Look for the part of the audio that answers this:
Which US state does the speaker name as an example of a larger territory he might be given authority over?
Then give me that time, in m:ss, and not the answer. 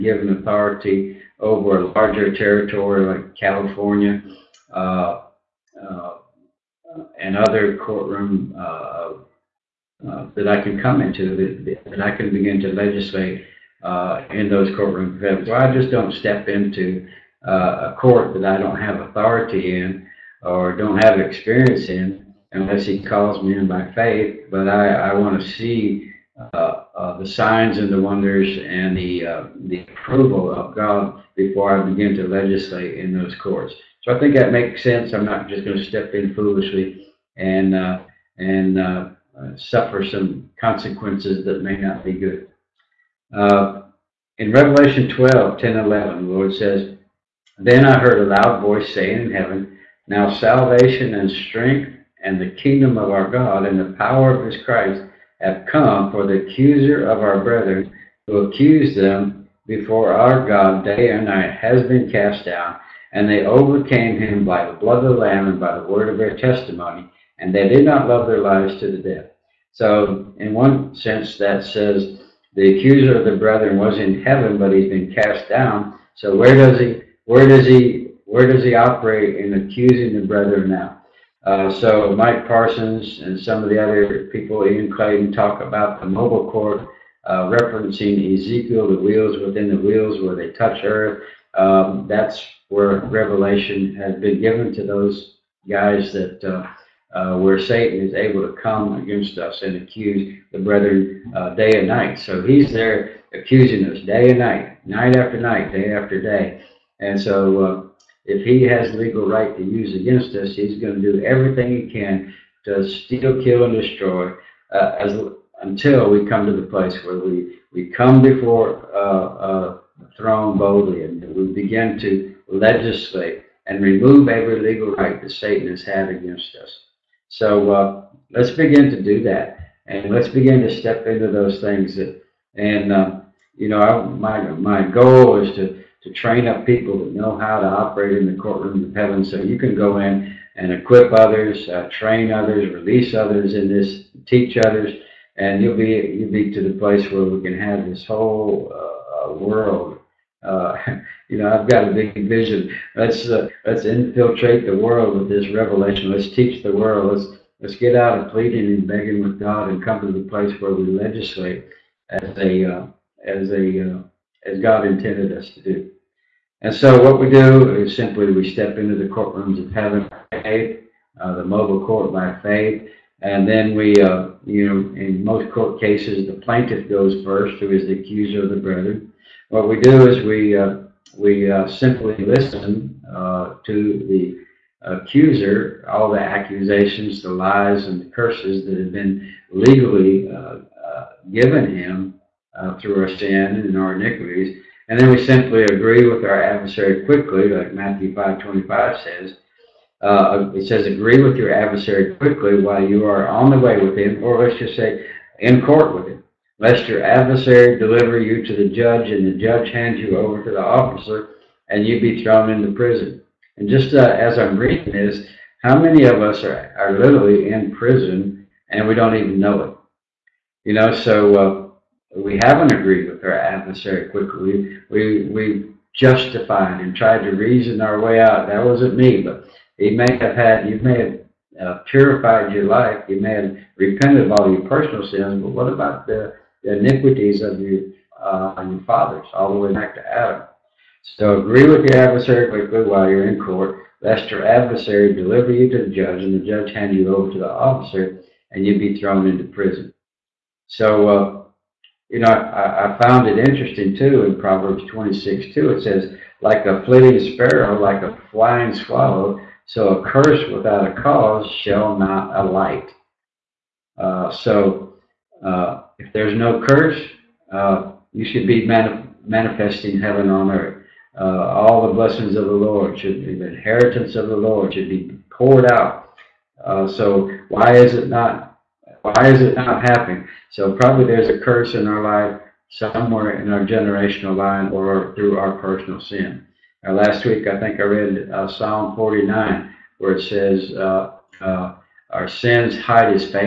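0:03.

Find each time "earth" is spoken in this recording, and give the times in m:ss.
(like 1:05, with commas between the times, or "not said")
1:30, 4:30.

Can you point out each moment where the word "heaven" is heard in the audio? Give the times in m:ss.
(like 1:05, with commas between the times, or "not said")
0:49, 1:14, 2:18, 2:49, 4:30.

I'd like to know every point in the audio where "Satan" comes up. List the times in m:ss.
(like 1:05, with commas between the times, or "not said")
1:37, 2:05.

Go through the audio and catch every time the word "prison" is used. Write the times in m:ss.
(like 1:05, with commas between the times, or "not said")
3:32, 3:37, 4:09.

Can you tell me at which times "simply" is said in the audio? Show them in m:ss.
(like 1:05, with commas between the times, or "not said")
2:47, 3:01, 3:15.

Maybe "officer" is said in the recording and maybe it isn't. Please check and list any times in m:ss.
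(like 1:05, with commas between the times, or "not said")
3:30, 4:07.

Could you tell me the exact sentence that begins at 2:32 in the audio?
Let's uh, let's infiltrate the world with this revelation.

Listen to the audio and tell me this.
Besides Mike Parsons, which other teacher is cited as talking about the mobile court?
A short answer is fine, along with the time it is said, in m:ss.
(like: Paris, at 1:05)
Ian Clayton, at 1:24.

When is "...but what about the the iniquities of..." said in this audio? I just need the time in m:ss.
3:55.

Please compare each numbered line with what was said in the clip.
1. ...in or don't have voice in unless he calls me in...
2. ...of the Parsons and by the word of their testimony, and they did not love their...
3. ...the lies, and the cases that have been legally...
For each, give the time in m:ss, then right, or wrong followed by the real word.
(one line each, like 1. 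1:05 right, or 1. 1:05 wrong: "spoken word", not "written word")
1. 0:19 wrong: "experience", not "voice"
2. 1:05 wrong: "Lamb", not "Parsons"
3. 3:07 wrong: "curses", not "cases".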